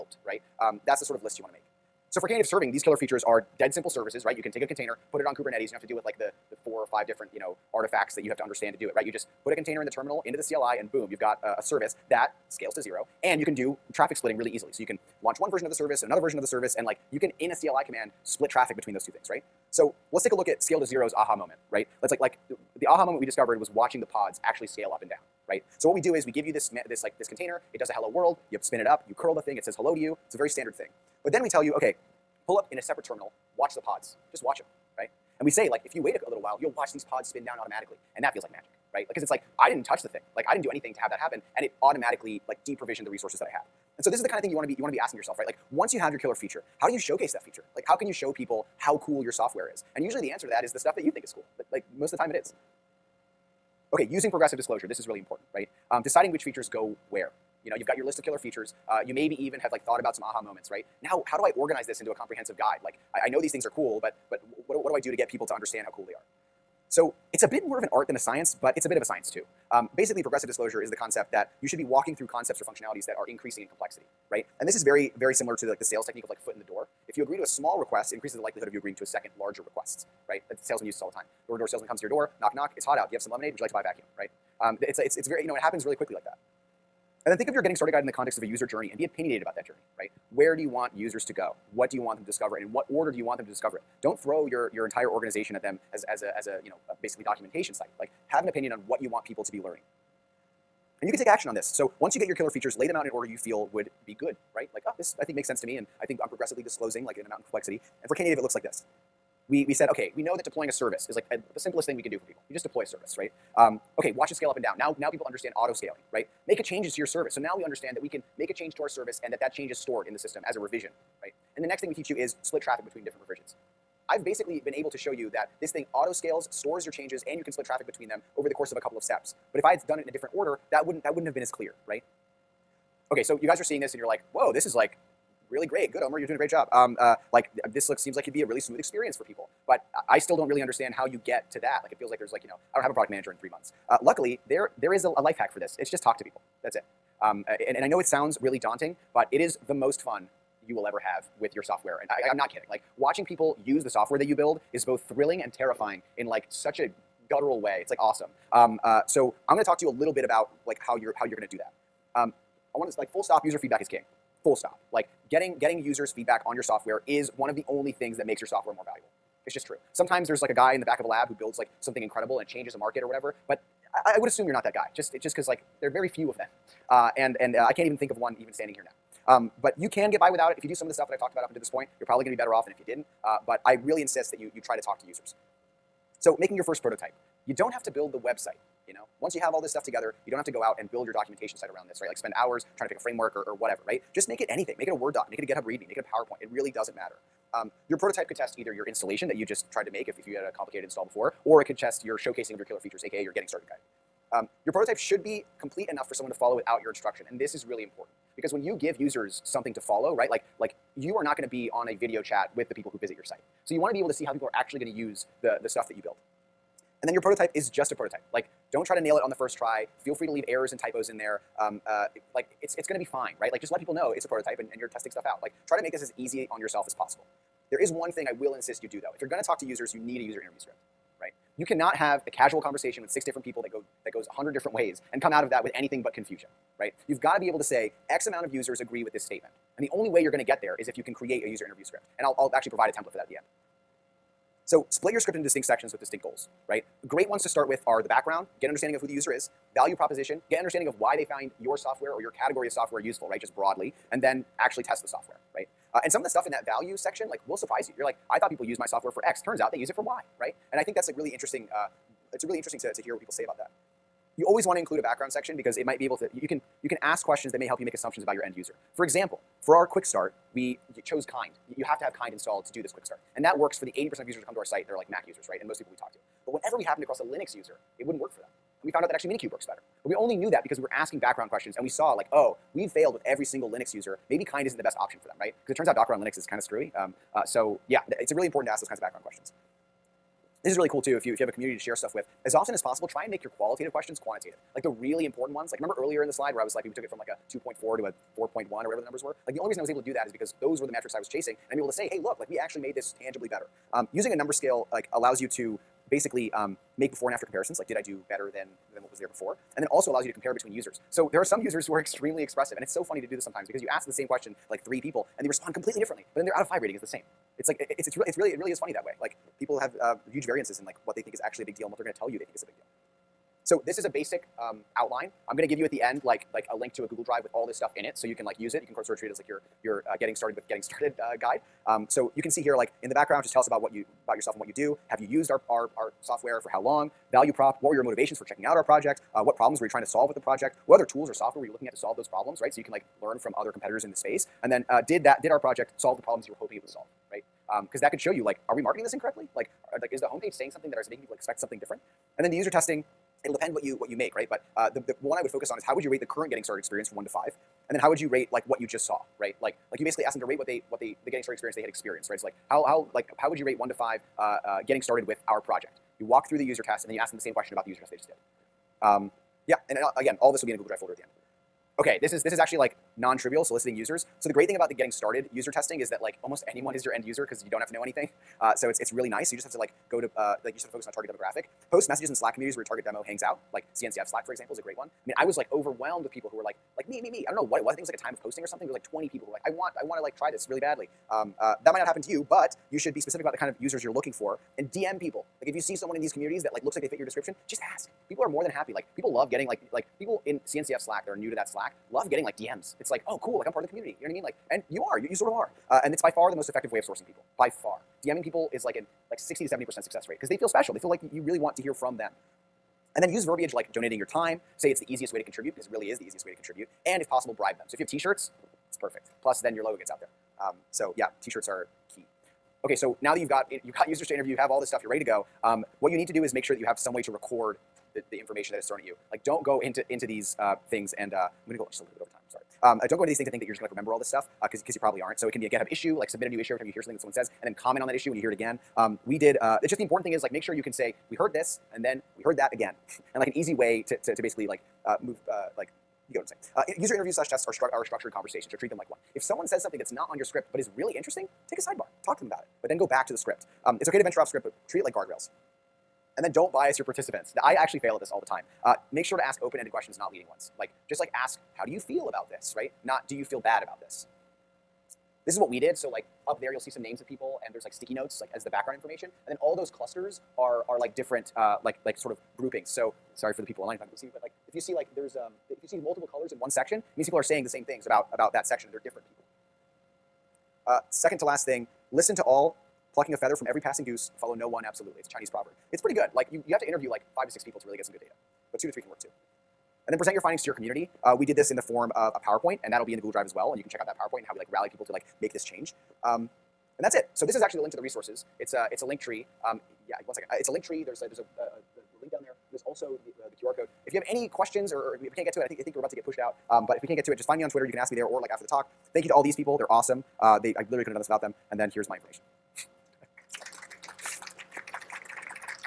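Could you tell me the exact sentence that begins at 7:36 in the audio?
And then don't bias your participants.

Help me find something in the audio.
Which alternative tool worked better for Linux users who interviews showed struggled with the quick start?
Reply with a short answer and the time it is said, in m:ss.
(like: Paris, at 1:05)
Minikube, at 4:39.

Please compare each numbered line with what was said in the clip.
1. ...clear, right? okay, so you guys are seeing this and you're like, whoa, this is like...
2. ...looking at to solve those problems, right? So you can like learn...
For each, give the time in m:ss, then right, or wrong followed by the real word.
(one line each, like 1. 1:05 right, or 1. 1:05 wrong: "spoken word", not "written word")
1. 2:11 right
2. 5:41 right.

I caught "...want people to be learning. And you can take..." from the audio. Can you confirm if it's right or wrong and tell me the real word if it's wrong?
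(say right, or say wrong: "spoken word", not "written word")
right.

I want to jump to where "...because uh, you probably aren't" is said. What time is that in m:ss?
7:14.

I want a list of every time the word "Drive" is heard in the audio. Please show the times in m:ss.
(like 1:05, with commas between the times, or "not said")
5:27, 6:10, 8:13.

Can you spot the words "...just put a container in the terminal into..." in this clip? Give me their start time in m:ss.
0:09.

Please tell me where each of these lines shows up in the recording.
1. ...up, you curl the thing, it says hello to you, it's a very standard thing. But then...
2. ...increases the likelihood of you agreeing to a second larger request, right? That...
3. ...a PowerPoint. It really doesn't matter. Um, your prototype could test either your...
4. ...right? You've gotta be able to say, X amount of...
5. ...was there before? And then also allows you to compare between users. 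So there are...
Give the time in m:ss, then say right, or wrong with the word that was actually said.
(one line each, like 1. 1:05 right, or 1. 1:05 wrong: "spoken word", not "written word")
1. 0:28 right
2. 1:18 right
3. 3:16 right
4. 3:56 right
5. 5:09 right.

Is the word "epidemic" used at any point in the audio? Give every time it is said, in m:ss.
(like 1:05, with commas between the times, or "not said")
not said.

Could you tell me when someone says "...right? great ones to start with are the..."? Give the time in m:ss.
4:06.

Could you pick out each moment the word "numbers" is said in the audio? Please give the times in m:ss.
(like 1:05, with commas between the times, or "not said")
4:59, 5:04.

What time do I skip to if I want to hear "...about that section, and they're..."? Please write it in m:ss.
7:58.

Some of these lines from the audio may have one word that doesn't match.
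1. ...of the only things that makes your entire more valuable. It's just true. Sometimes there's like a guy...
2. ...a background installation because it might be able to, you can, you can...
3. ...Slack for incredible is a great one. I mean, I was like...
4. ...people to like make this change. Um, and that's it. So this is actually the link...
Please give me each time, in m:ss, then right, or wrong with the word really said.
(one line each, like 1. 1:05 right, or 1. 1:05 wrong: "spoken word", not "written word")
1. 2:47 wrong: "software", not "entire"
2. 4:24 wrong: "section", not "installation"
3. 6:24 wrong: "example", not "incredible"
4. 8:14 right.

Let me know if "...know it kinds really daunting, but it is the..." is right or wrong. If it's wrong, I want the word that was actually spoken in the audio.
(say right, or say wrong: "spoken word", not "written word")
wrong: "sounds", not "kinds".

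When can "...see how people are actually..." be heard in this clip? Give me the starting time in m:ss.
3:34.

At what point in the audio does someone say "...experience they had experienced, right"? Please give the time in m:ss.
6:01.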